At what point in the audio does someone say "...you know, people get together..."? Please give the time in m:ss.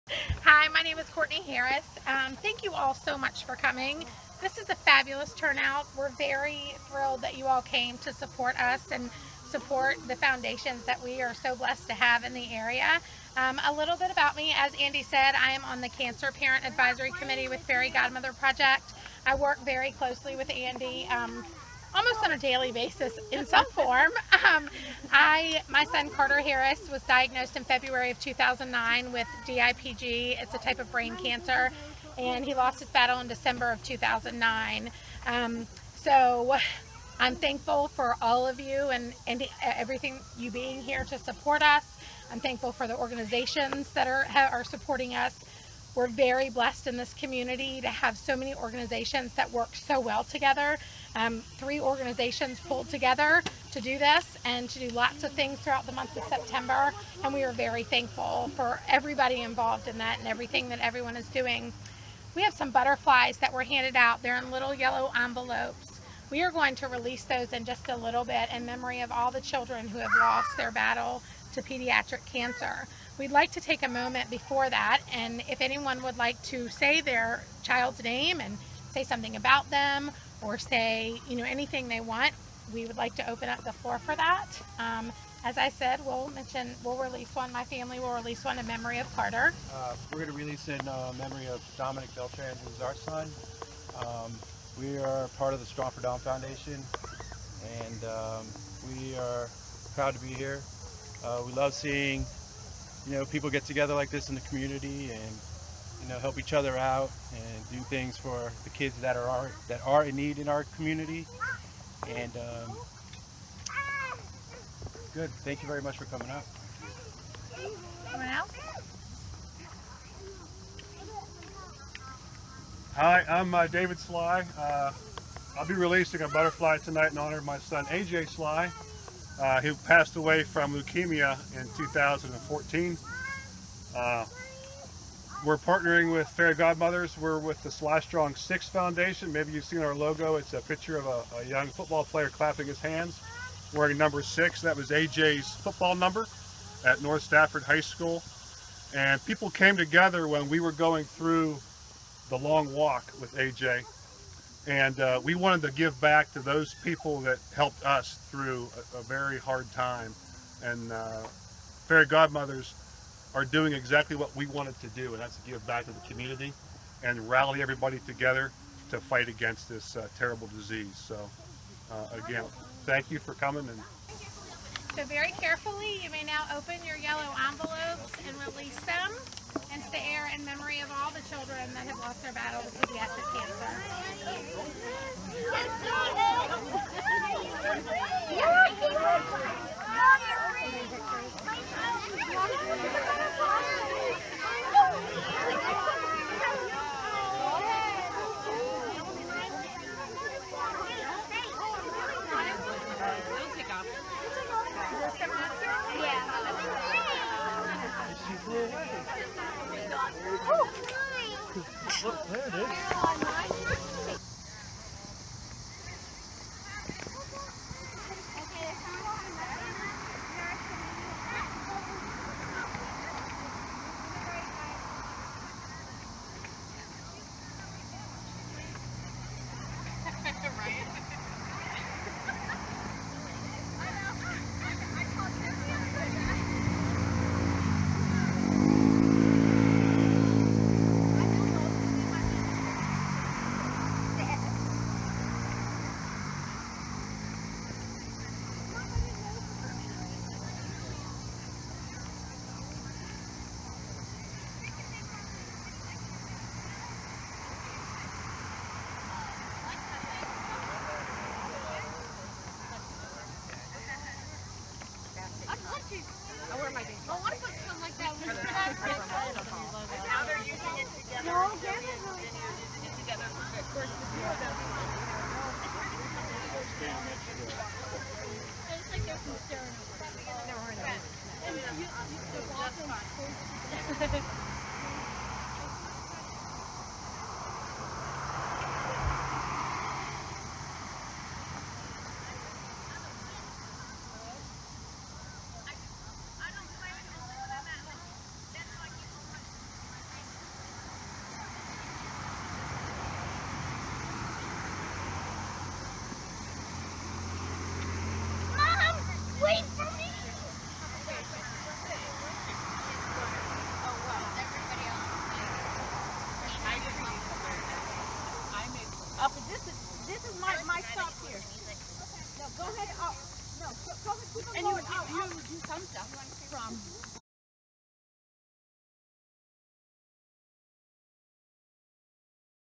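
1:43.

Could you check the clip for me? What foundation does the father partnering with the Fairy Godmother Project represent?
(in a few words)
Sly Strong Six Foundation.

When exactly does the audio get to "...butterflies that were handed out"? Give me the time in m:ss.
1:02.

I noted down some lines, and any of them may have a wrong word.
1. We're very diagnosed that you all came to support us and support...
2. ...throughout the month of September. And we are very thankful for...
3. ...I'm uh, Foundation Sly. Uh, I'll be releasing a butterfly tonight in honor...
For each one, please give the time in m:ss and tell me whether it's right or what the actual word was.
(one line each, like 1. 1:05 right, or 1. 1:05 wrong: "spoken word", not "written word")
1. 0:05 wrong: "thrilled", not "diagnosed"
2. 0:55 right
3. 2:03 wrong: "David", not "Foundation".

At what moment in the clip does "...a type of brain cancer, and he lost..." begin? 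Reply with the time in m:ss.
0:30.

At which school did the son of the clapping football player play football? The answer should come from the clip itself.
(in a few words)
North Stafford High School.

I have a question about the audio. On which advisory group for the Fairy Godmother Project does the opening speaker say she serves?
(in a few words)
Cancer Parent Advisory Committee.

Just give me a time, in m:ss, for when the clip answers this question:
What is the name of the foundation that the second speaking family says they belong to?
1:35.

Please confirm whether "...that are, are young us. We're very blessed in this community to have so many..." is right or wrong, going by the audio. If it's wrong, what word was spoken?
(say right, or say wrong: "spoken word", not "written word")
wrong: "supporting", not "young".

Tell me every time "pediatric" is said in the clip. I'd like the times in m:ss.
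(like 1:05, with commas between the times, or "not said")
1:11, 3:02.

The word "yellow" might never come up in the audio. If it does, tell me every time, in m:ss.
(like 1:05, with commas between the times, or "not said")
1:04, 2:56.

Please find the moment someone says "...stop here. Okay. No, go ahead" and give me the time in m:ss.
5:20.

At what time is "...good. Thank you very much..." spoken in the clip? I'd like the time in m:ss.
1:55.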